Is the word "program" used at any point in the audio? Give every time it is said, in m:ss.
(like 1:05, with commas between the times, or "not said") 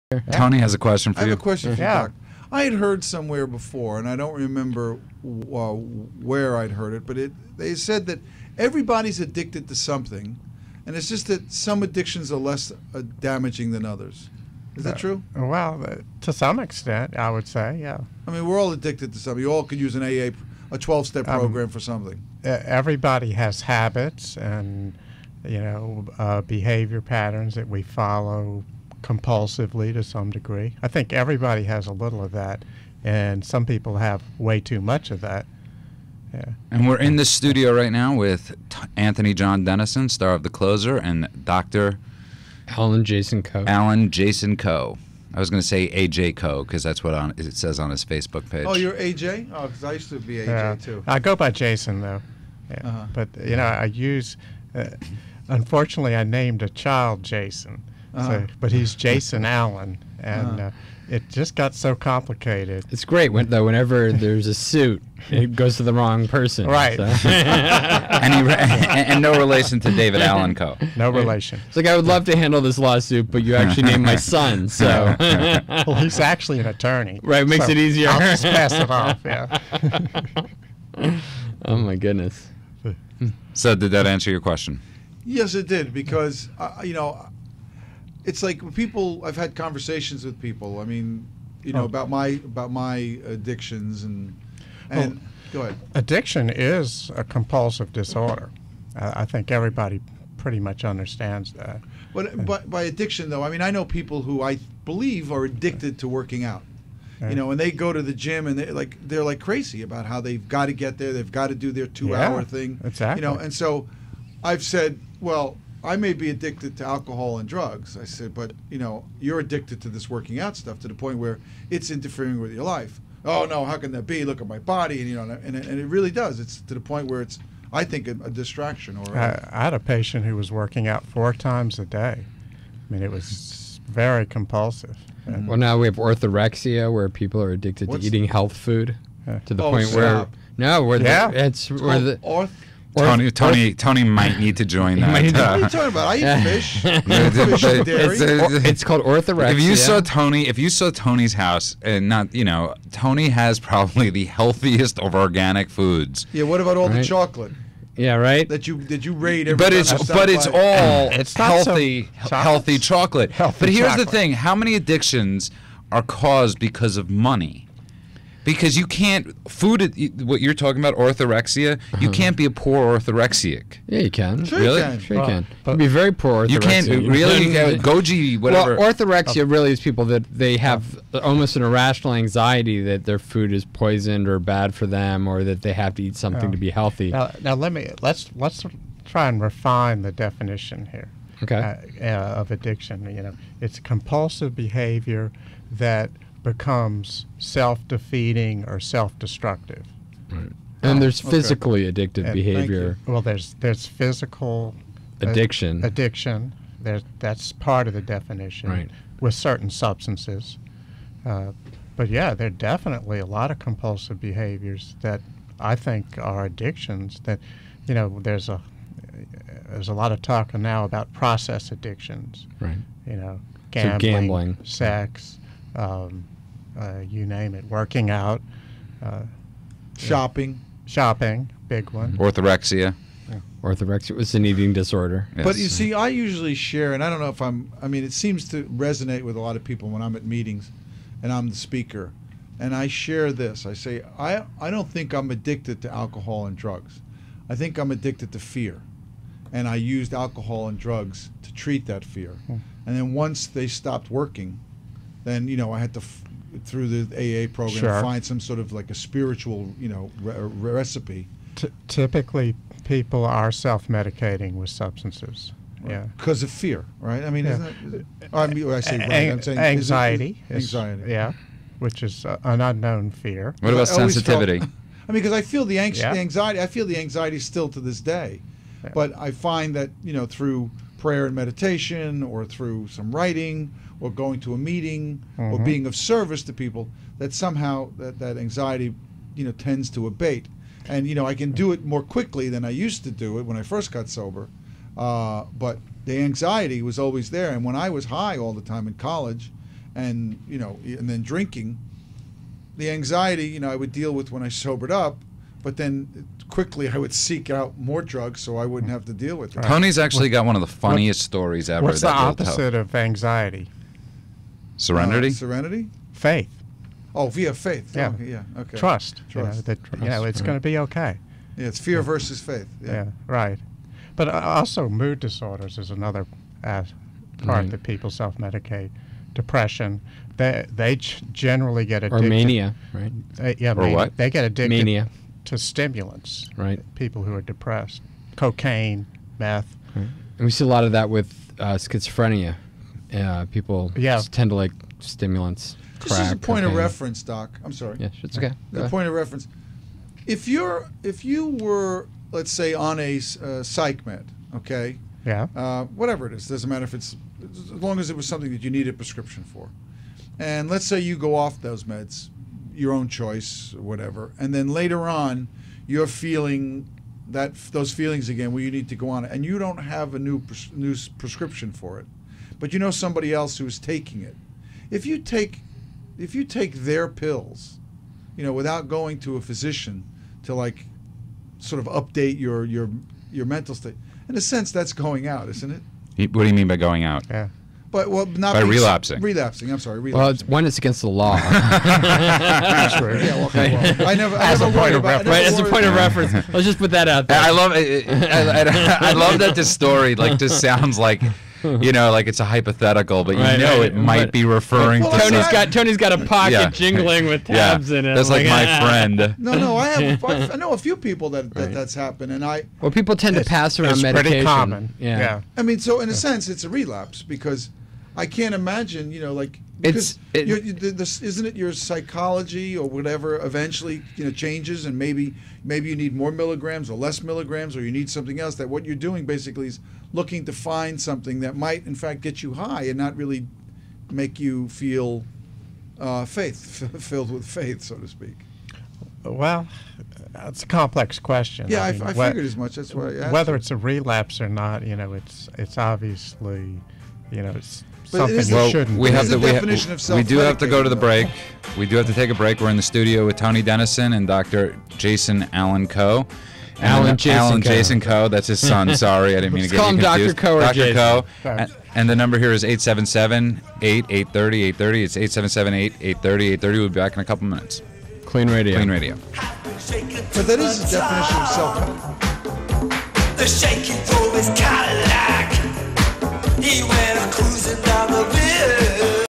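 0:21, 4:17.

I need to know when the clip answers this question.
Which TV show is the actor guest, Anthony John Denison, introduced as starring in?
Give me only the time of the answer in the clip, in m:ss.
0:40.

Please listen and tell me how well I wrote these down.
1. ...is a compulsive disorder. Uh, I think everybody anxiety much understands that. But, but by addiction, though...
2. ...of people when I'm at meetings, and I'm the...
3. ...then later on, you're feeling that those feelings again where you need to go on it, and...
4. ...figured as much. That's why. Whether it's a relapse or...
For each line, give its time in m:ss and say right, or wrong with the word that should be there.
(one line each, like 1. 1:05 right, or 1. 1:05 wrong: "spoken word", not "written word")
1. 1:36 wrong: "pretty", not "anxiety"
2. 3:59 right
3. 6:04 right
4. 7:22 right.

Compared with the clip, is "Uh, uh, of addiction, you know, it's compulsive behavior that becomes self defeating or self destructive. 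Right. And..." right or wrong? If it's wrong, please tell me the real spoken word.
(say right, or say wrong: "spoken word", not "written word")
right.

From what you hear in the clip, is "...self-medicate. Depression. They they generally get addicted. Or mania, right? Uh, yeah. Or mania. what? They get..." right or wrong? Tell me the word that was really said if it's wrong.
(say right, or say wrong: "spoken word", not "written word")
right.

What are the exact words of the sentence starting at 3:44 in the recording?
sex, um, uh, you name it, working out, uh, shopping, shopping, big one, mm-hmm.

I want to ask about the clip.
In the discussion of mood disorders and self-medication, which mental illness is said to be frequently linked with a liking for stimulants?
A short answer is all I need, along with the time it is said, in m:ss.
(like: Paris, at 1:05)
schizophrenia, at 5:41.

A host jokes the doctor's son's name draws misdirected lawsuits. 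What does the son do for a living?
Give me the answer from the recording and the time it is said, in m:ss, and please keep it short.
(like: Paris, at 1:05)
attorney, at 1:16.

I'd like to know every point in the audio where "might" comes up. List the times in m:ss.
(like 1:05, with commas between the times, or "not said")
2:24, 6:43, 7:11.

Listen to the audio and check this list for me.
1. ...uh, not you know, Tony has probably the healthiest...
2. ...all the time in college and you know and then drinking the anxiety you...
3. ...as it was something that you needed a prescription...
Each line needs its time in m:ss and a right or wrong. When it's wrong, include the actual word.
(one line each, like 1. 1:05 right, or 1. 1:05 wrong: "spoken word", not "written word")
1. 2:32 right
2. 4:58 right
3. 5:57 right.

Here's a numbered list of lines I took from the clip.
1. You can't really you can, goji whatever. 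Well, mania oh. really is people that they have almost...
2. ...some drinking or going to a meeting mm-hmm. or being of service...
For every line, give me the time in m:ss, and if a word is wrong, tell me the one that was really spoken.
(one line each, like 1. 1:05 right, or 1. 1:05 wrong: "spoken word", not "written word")
1. 2:56 wrong: "orthorexia", not "mania"
2. 4:42 wrong: "writing", not "drinking".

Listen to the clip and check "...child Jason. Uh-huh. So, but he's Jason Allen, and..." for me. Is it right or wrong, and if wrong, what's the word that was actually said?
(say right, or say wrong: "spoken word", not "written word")
right.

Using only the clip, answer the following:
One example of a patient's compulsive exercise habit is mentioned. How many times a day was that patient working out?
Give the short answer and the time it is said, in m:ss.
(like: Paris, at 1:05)
4, at 2:11.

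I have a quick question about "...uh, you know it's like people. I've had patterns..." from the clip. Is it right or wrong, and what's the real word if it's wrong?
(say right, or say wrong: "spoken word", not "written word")
wrong: "conversations", not "patterns".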